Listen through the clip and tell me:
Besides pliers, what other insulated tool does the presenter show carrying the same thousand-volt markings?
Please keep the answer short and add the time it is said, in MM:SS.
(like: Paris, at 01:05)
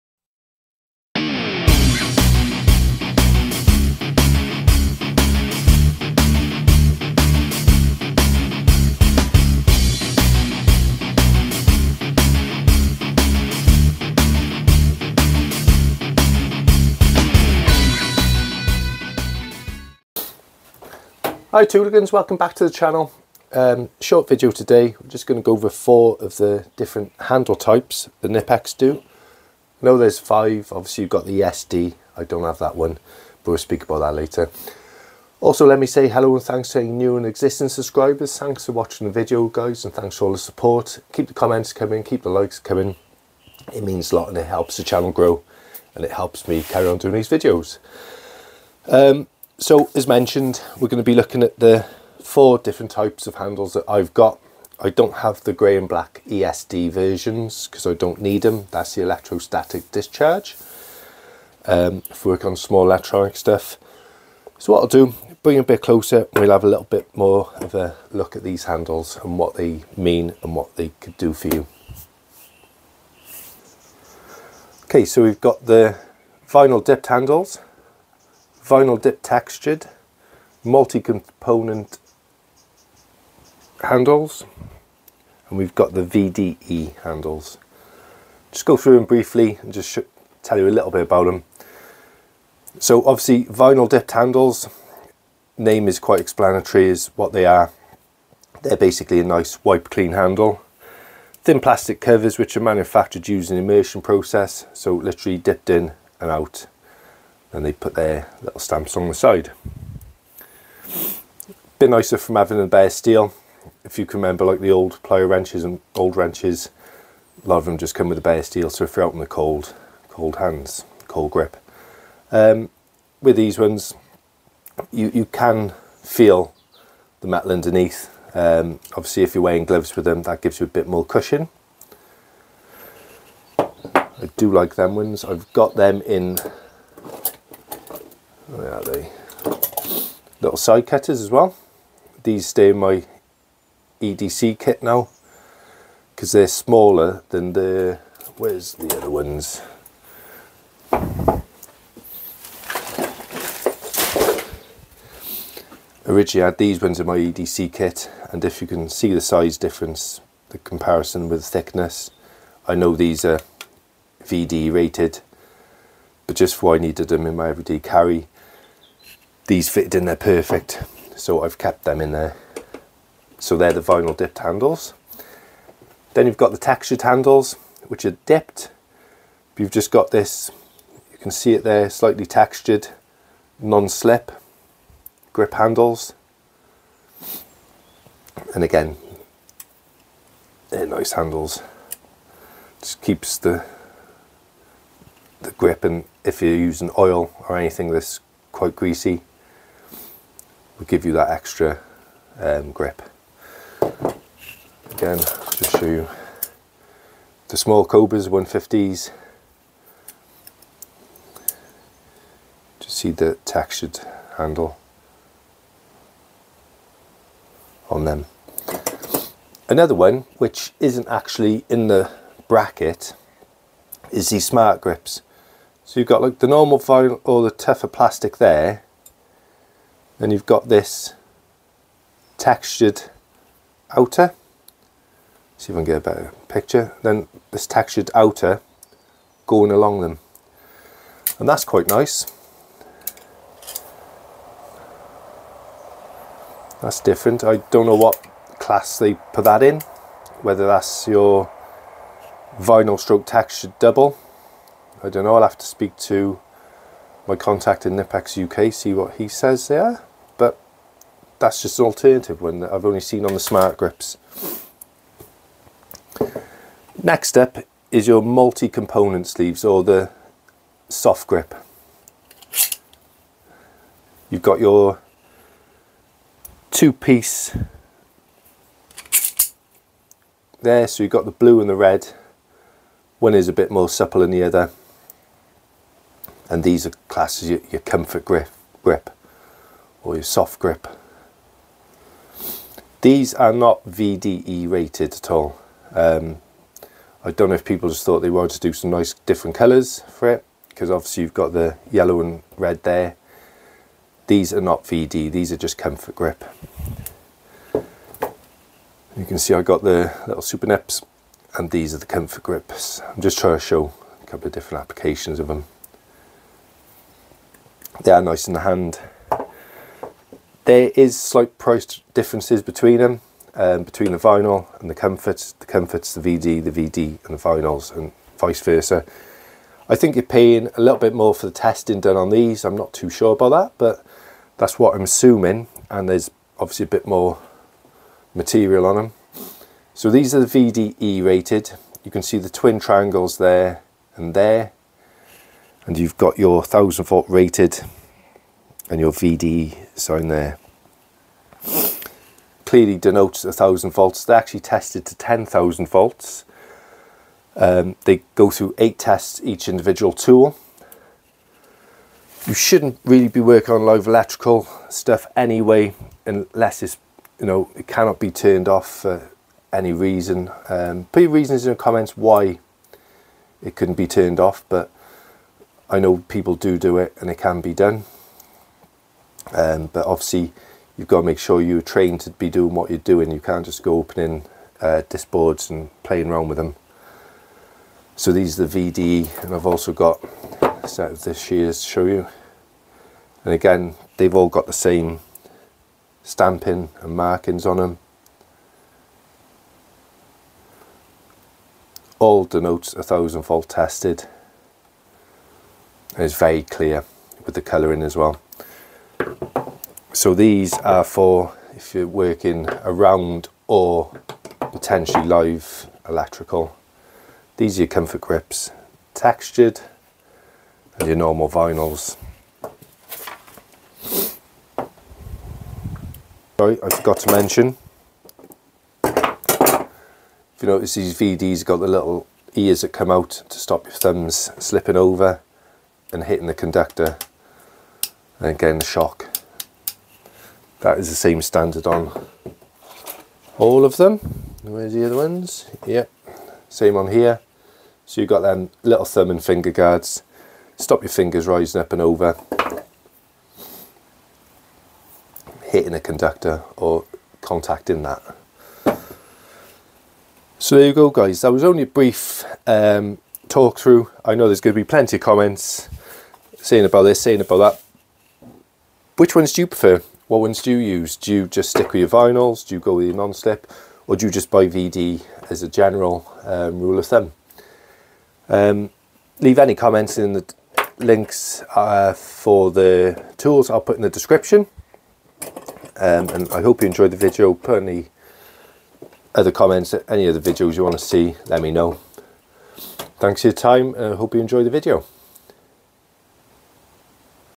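Shears, at 06:31.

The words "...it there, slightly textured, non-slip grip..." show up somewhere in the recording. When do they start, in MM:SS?
03:01.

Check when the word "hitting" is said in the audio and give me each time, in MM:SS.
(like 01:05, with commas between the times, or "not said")
07:16, 07:35.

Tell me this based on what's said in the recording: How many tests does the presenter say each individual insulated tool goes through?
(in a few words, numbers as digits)
8.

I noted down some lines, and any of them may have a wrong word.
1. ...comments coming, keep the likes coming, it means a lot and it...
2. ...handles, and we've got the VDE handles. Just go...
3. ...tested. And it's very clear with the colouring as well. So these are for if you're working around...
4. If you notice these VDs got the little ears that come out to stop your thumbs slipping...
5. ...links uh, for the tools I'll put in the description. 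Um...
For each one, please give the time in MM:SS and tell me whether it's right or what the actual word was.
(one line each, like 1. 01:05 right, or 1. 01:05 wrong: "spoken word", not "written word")
1. 00:41 right
2. 01:23 right
3. 06:43 right
4. 07:09 right
5. 08:00 right.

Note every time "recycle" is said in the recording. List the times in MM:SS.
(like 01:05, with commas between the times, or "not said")
not said.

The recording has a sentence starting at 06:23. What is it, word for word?
You can't just go opening uh, disc boards and playing around with them.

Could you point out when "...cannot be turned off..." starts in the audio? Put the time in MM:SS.
06:07.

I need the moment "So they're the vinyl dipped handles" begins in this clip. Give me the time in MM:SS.
02:53.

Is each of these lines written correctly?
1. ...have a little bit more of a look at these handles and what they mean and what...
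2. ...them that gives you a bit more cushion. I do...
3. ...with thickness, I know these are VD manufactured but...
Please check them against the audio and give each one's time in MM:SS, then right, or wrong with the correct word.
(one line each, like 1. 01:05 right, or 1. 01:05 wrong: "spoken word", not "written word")
1. 01:06 right
2. 02:10 right
3. 02:41 wrong: "rated", not "manufactured".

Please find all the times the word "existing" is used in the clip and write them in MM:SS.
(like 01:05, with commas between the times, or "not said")
00:37.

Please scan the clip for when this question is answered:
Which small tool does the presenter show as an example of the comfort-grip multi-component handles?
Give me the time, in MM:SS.
05:10.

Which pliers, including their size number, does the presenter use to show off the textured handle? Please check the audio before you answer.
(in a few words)
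Cobras 150s.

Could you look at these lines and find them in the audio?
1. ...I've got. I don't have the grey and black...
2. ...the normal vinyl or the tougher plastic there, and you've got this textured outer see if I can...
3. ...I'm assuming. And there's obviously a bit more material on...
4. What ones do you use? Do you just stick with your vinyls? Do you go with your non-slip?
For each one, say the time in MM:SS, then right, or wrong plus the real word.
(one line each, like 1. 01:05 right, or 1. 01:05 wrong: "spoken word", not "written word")
1. 00:53 right
2. 03:46 right
3. 05:34 right
4. 07:50 right.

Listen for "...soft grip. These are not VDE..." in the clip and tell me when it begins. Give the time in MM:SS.
04:50.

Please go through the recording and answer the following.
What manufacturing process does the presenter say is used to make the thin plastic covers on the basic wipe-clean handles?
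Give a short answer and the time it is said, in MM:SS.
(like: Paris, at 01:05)
Immersion process, at 01:43.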